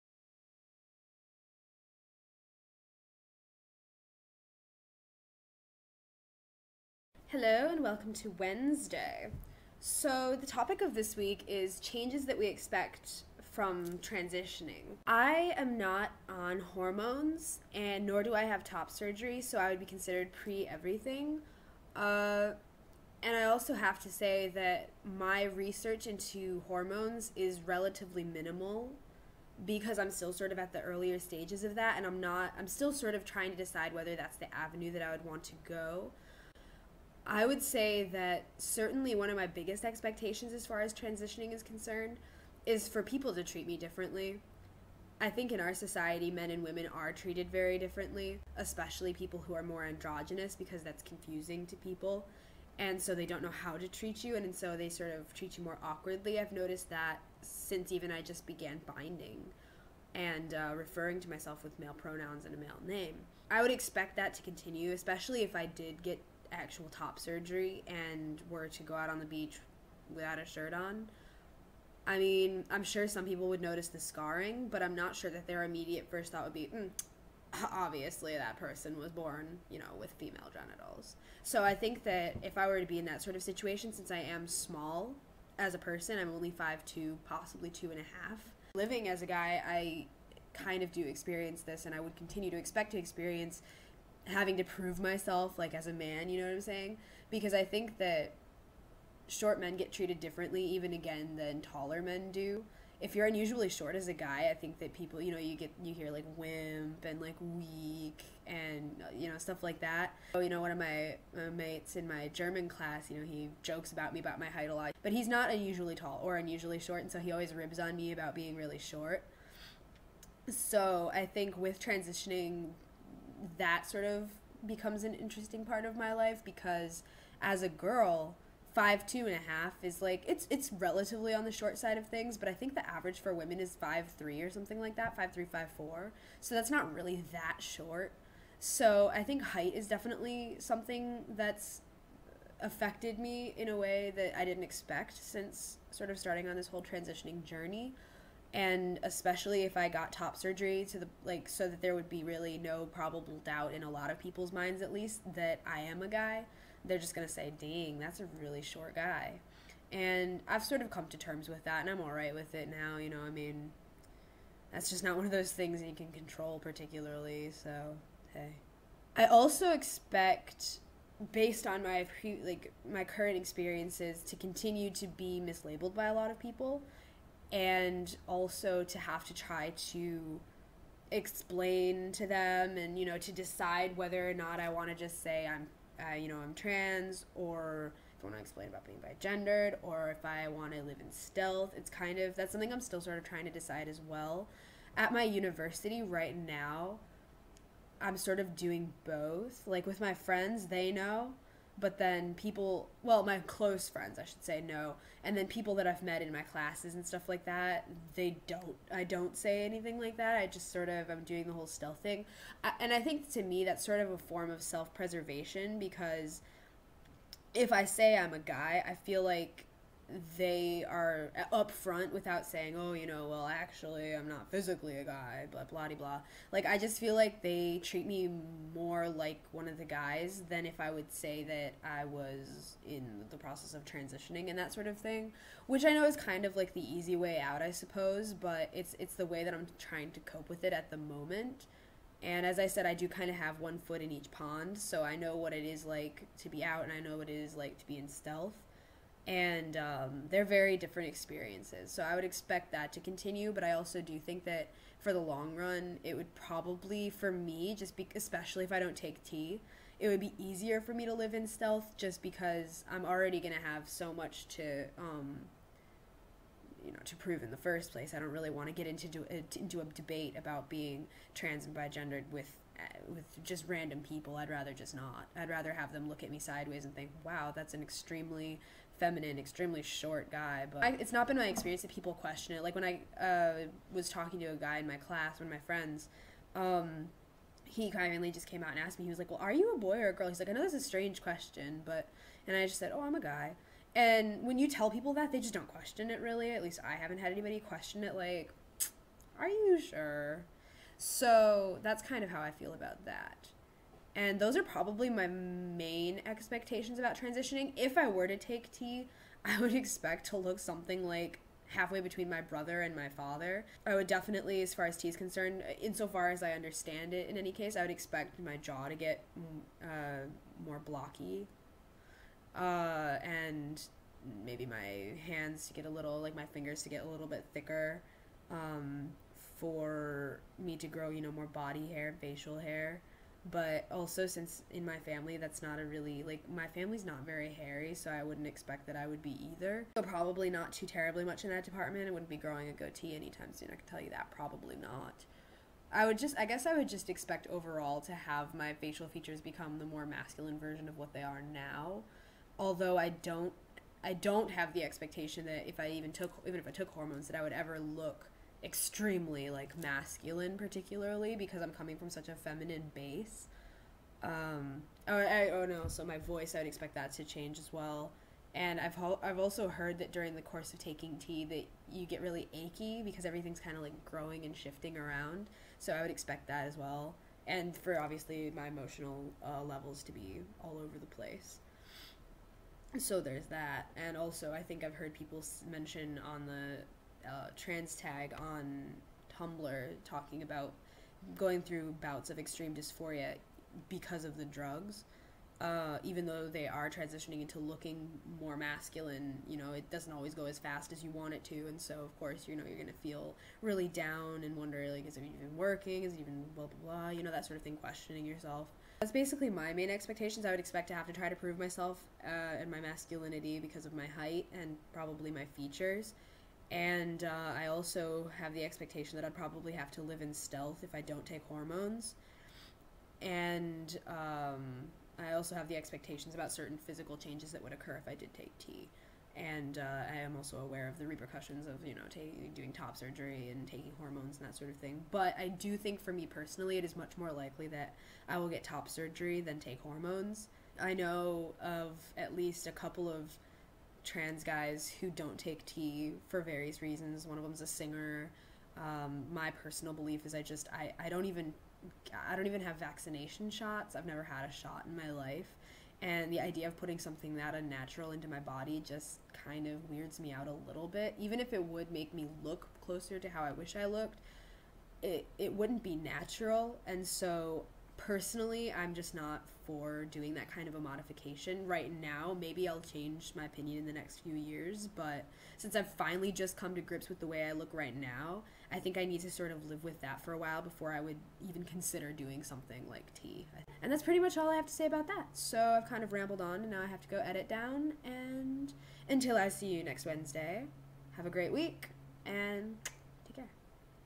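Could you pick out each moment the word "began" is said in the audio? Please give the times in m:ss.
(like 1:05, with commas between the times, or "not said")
0:58.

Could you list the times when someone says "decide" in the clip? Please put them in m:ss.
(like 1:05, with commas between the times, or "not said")
0:33, 3:03, 3:13.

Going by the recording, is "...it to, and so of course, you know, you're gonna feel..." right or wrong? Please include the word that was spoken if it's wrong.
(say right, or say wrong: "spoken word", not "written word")
right.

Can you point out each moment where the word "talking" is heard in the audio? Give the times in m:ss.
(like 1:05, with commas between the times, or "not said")
4:44, 6:30.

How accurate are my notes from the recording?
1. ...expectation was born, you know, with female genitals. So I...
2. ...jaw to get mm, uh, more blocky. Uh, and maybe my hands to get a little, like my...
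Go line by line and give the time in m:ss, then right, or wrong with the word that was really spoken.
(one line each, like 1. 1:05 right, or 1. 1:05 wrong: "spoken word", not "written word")
1. 1:18 wrong: "person", not "expectation"
2. 5:18 right.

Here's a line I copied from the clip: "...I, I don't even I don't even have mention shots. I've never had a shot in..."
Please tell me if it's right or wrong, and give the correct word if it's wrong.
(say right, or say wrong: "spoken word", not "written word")
wrong: "vaccination", not "mention".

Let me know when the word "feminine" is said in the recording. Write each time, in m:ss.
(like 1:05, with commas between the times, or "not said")
4:38, 6:02.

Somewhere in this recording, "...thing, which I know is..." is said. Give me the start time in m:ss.
3:54.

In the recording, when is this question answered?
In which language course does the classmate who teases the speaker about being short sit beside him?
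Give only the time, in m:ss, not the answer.
1:52.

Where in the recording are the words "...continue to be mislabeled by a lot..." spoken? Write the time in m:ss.
2:54.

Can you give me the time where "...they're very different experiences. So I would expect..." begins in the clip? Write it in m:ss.
4:10.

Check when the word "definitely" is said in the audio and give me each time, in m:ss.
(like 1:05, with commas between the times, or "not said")
2:19, 5:14.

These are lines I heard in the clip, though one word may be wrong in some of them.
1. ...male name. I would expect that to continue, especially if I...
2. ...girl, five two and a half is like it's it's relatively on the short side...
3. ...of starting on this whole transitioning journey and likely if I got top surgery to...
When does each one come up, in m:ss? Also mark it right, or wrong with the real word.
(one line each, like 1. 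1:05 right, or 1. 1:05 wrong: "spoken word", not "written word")
1. 1:02 right
2. 2:07 right
3. 2:26 wrong: "especially", not "likely".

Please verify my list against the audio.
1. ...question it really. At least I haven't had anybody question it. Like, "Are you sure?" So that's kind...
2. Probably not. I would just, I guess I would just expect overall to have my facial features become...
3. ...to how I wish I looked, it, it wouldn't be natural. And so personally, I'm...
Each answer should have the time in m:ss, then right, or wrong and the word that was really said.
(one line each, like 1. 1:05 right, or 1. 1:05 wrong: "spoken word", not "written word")
1. 4:55 right
2. 5:44 right
3. 7:43 right.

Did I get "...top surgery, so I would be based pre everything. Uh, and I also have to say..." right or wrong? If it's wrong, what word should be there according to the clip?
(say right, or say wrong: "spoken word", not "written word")
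wrong: "considered", not "based".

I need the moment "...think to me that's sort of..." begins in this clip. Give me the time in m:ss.
3:33.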